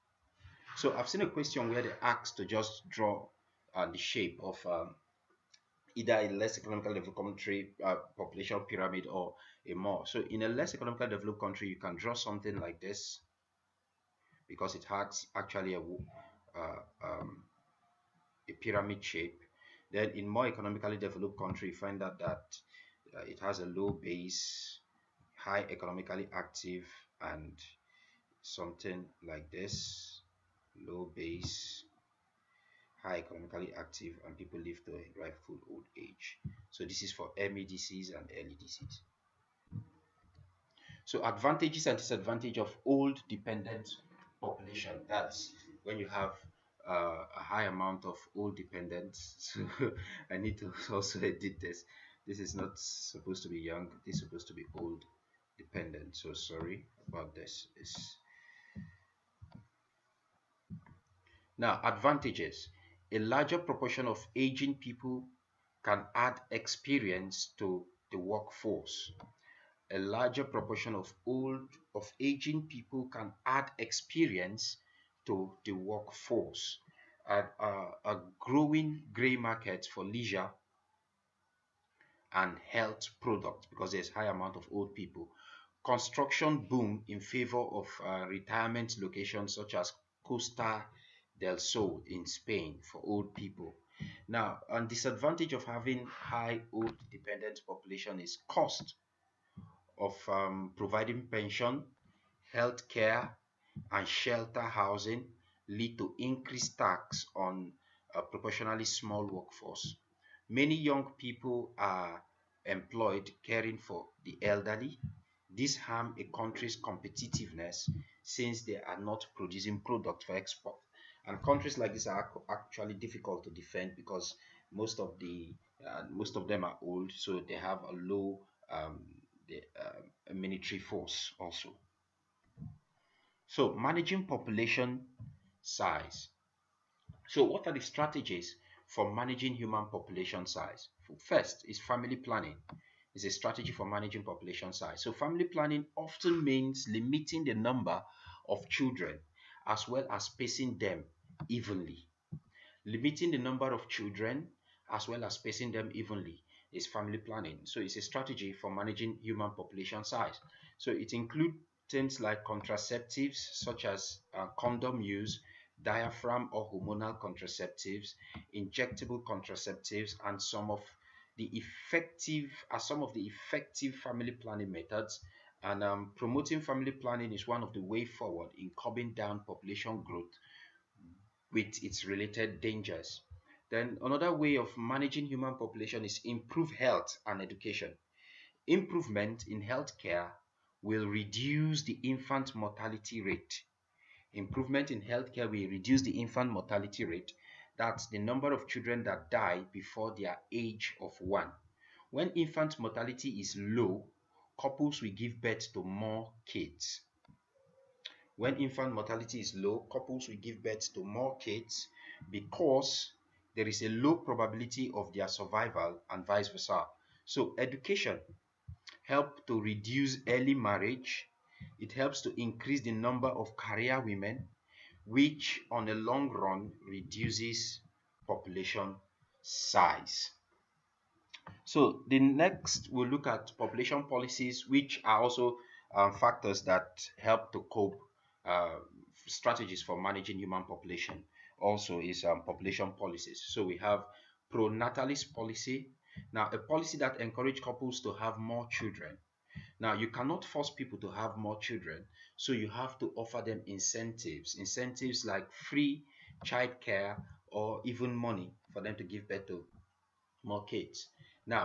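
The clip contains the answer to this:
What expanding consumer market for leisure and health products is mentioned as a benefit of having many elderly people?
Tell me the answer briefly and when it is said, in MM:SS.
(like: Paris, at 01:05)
grey market, at 01:19.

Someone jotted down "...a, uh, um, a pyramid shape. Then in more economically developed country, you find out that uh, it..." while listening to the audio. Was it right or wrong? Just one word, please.
right.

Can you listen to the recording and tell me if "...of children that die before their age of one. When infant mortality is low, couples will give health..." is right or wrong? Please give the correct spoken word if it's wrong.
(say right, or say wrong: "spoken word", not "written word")
wrong: "birth", not "health".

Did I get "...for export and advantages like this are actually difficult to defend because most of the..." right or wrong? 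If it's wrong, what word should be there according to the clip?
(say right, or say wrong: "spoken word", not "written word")
wrong: "countries", not "advantages".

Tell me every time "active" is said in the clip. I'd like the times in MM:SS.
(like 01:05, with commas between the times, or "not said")
00:26, 00:33.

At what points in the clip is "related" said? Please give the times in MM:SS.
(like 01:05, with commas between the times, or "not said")
03:02.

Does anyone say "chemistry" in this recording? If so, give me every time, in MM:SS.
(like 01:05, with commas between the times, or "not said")
not said.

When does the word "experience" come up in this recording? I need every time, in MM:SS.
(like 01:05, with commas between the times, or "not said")
01:06, 01:13.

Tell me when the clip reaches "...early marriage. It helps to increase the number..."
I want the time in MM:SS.
03:40.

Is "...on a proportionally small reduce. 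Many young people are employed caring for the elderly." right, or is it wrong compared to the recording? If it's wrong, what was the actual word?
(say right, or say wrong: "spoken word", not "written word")
wrong: "workforce", not "reduce".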